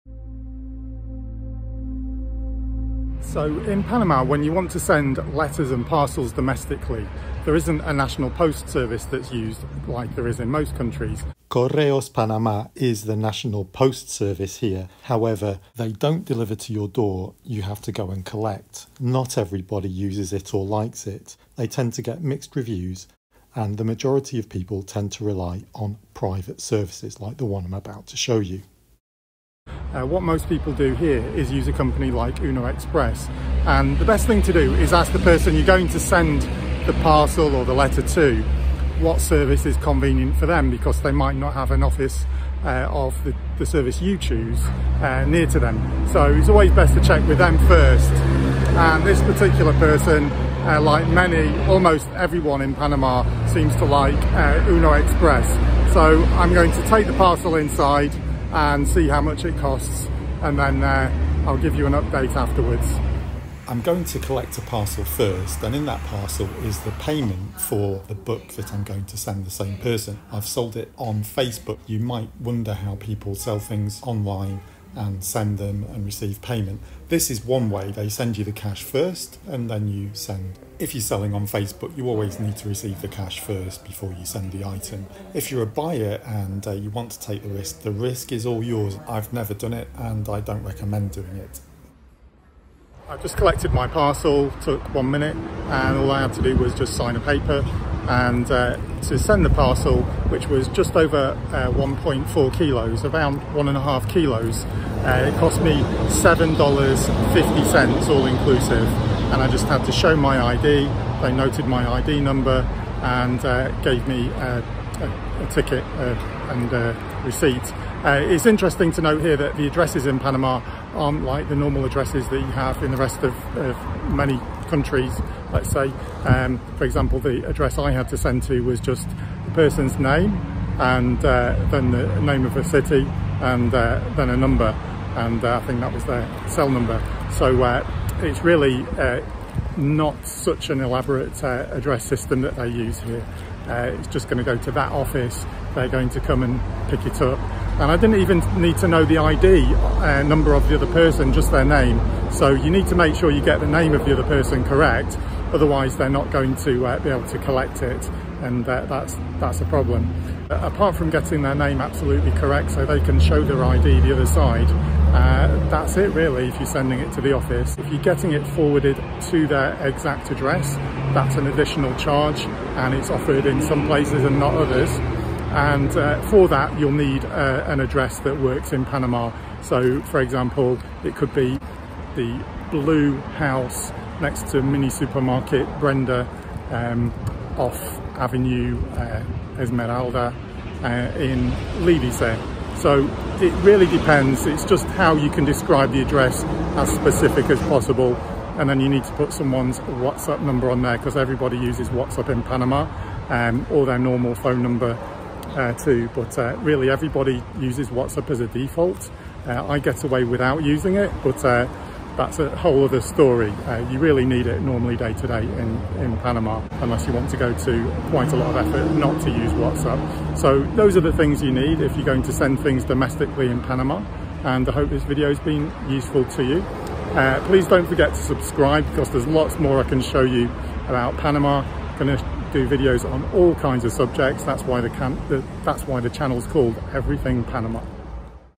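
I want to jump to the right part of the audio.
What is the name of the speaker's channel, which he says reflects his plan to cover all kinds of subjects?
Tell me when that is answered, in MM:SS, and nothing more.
03:56.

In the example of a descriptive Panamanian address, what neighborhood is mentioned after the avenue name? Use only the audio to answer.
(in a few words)
Lidice.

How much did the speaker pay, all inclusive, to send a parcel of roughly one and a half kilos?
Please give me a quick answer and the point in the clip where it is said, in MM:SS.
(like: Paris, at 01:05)
$7.50, at 01:46.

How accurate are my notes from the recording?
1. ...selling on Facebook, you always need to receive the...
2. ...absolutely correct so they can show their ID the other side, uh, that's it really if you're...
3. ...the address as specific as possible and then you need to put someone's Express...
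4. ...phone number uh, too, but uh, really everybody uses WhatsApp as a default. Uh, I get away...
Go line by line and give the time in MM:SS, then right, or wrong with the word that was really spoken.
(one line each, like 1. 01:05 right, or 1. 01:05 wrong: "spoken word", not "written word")
1. 01:21 right
2. 02:41 right
3. 03:15 wrong: "WhatsApp", not "Express"
4. 03:24 right.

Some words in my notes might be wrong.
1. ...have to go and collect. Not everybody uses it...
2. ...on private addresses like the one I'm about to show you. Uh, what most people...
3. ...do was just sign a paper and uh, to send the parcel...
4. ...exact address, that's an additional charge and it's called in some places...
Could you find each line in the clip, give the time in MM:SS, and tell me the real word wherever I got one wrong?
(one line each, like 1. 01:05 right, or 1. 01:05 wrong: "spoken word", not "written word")
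1. 00:17 right
2. 00:25 wrong: "services", not "addresses"
3. 01:36 right
4. 02:49 wrong: "offered", not "called".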